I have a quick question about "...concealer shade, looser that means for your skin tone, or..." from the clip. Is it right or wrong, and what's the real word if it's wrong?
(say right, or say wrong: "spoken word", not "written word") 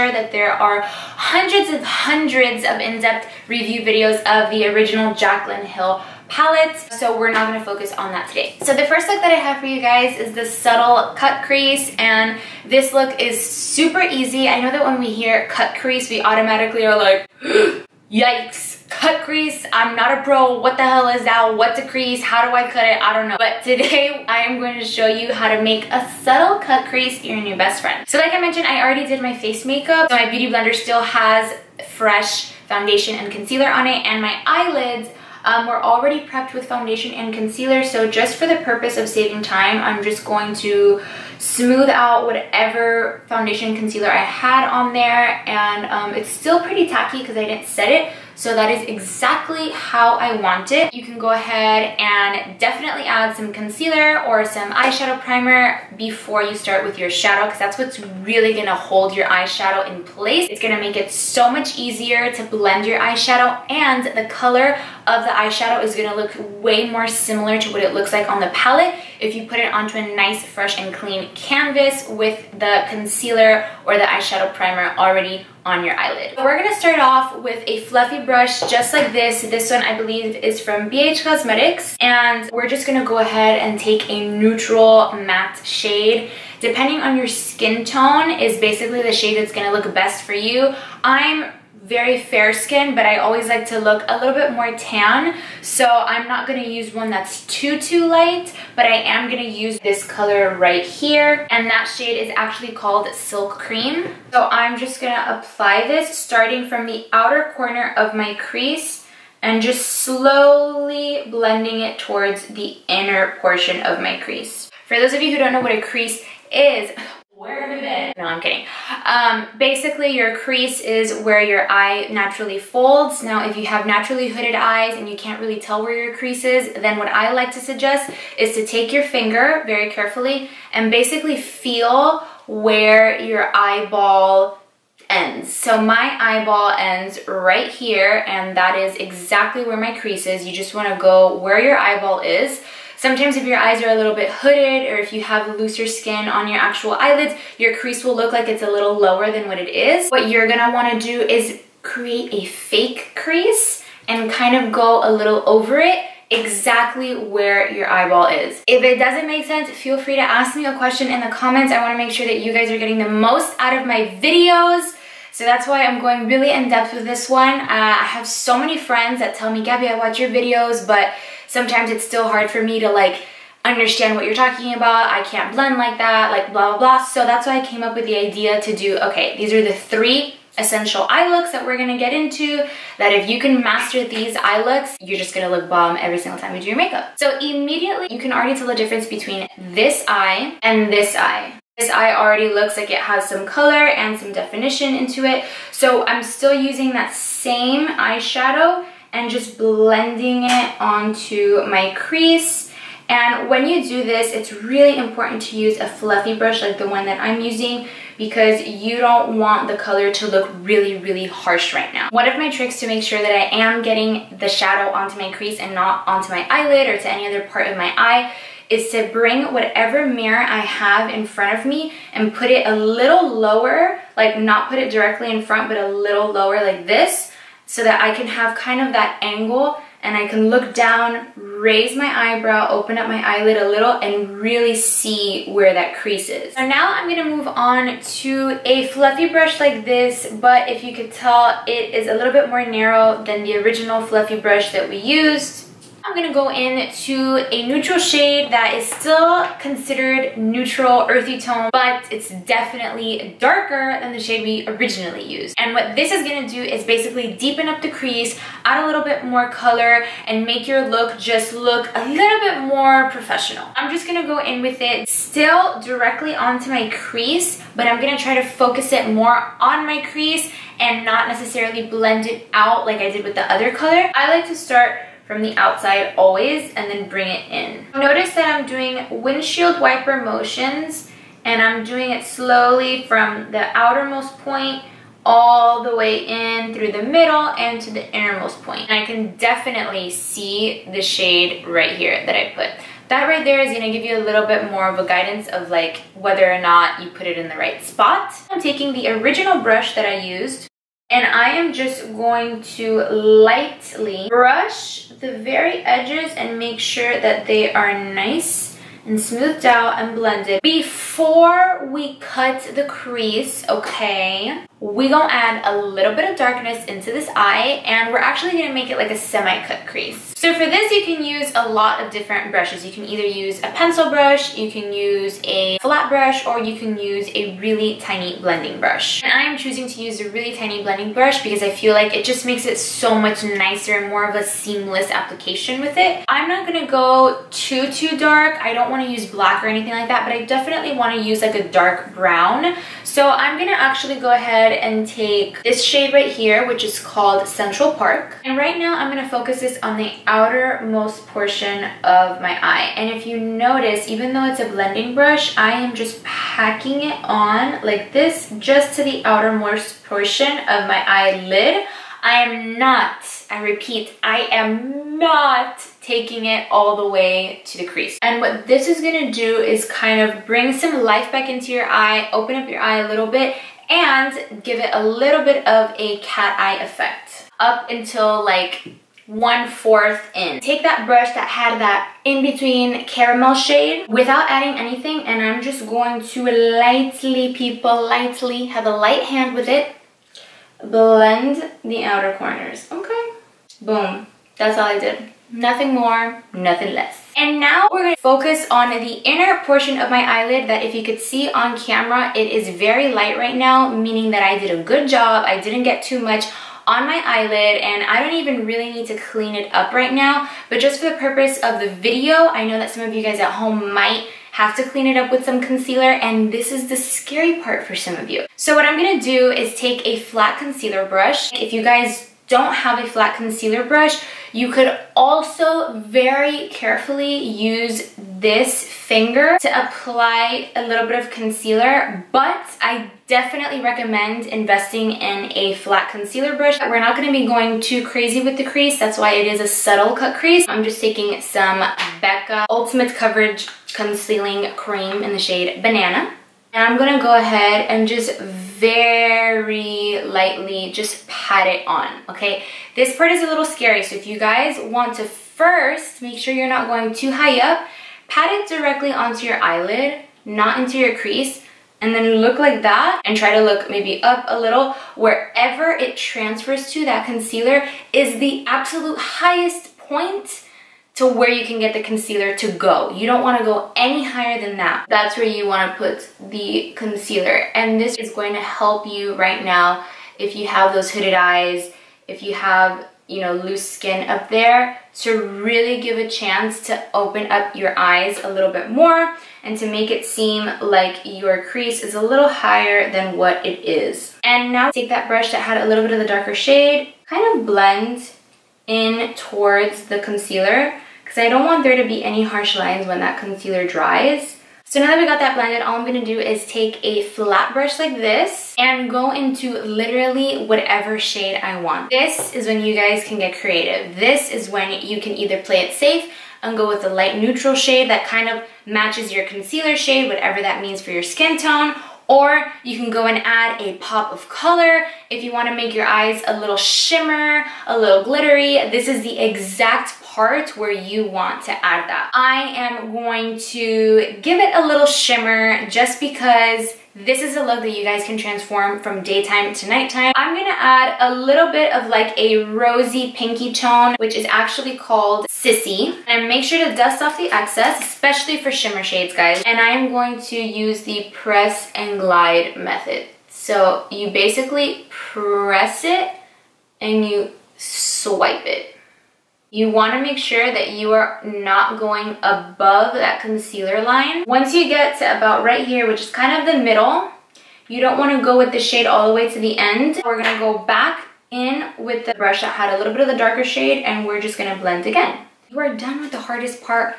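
wrong: "whatever", not "looser".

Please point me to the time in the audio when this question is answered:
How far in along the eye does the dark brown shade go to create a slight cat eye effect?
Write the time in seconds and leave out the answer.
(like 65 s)
379 s.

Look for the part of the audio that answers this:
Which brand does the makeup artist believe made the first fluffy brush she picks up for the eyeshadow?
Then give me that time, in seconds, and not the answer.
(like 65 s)
80 s.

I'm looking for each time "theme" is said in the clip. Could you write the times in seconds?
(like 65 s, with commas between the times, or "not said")
not said.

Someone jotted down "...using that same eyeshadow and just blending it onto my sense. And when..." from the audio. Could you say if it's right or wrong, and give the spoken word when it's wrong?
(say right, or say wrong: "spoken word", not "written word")
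wrong: "crease", not "sense".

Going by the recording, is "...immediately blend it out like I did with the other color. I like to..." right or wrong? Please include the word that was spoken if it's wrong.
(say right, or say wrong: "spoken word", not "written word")
wrong: "necessarily", not "immediately".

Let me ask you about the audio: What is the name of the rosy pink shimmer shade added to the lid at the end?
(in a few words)
Sissy.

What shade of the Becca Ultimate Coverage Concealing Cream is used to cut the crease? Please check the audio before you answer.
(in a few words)
Banana.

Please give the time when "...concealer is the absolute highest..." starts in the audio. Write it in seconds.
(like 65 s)
467 s.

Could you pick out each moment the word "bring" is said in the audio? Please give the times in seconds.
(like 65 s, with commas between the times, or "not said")
219 s, 277 s, 370 s.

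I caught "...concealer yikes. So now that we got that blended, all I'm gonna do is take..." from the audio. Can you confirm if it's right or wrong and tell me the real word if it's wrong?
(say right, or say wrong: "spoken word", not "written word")
wrong: "dries", not "yikes".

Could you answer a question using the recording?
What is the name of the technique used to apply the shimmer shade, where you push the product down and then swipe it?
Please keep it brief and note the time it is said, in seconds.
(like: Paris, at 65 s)
press and glide, at 551 s.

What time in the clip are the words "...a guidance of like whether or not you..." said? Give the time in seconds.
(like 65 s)
294 s.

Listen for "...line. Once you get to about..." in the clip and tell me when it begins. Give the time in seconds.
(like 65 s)
564 s.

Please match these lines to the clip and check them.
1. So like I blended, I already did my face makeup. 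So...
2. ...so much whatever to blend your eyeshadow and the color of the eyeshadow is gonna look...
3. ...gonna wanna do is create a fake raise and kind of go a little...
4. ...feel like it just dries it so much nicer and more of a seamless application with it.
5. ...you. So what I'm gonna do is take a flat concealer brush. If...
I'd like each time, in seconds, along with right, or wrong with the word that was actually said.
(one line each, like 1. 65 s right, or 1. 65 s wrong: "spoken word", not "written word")
1. 28 s wrong: "mentioned", not "blended"
2. 61 s wrong: "easier", not "whatever"
3. 150 s wrong: "crease", not "raise"
4. 331 s wrong: "makes", not "dries"
5. 418 s right.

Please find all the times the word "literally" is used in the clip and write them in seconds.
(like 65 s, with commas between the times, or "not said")
509 s.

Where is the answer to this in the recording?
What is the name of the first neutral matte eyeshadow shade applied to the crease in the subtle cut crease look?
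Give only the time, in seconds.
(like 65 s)
103 s.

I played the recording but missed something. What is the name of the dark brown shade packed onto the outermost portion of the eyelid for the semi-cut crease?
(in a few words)
Central Park.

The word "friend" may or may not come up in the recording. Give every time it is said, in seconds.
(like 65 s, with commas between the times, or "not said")
27 s, 168 s.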